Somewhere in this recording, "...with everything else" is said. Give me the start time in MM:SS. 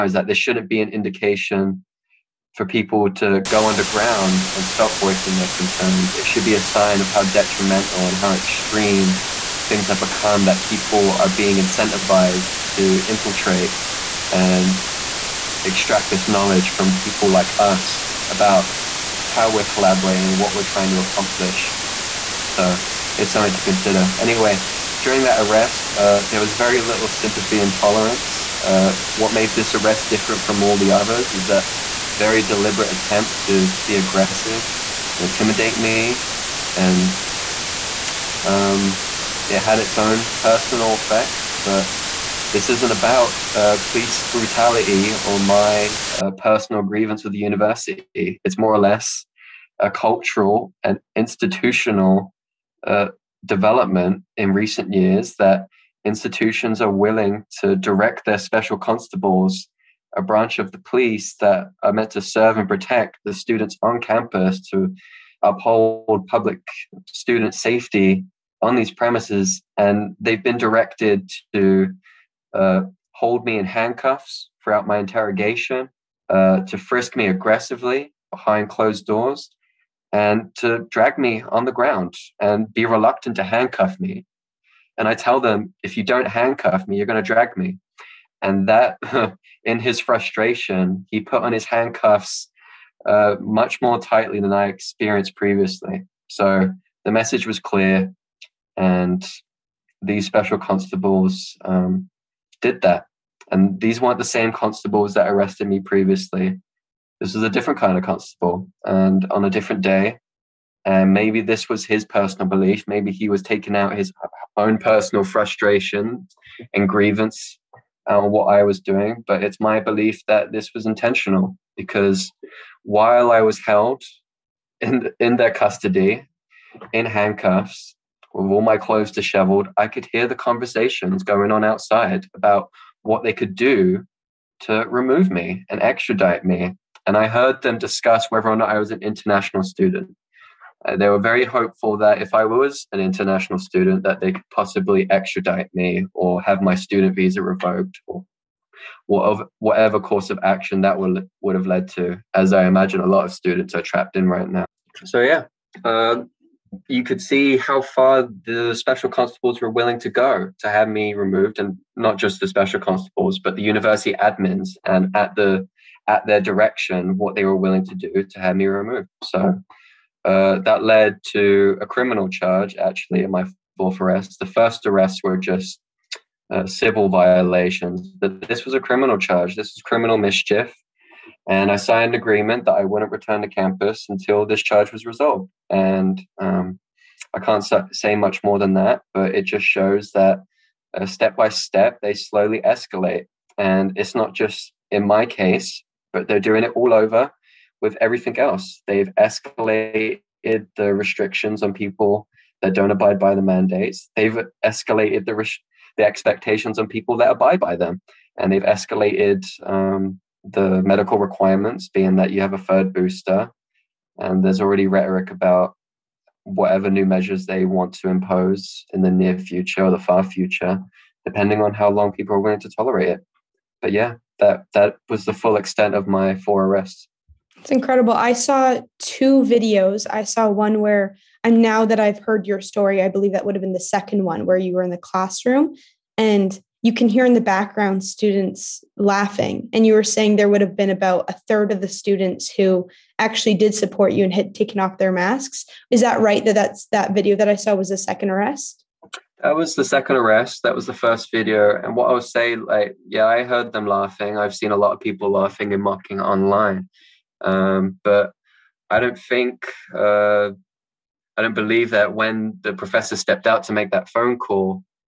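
03:17.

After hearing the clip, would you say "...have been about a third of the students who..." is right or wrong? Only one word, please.
right.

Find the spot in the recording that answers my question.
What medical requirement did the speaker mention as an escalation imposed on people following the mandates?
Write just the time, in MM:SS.
03:32.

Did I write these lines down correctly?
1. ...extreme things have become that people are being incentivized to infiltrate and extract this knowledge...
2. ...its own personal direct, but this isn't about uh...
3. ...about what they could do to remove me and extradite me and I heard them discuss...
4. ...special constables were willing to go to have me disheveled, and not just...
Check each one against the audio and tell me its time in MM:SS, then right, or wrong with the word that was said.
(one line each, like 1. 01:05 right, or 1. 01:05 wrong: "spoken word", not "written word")
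1. 00:08 right
2. 00:39 wrong: "effect", not "direct"
3. 02:12 right
4. 02:38 wrong: "removed", not "disheveled".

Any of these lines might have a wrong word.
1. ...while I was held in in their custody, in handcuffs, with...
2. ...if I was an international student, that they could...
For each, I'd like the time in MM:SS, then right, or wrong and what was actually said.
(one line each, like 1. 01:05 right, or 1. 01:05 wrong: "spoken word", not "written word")
1. 02:02 right
2. 02:22 right.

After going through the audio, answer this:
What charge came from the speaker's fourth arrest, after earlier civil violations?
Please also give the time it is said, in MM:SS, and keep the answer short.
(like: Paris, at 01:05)
criminal mischief, at 02:59.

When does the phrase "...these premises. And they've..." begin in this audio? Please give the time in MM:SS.
01:08.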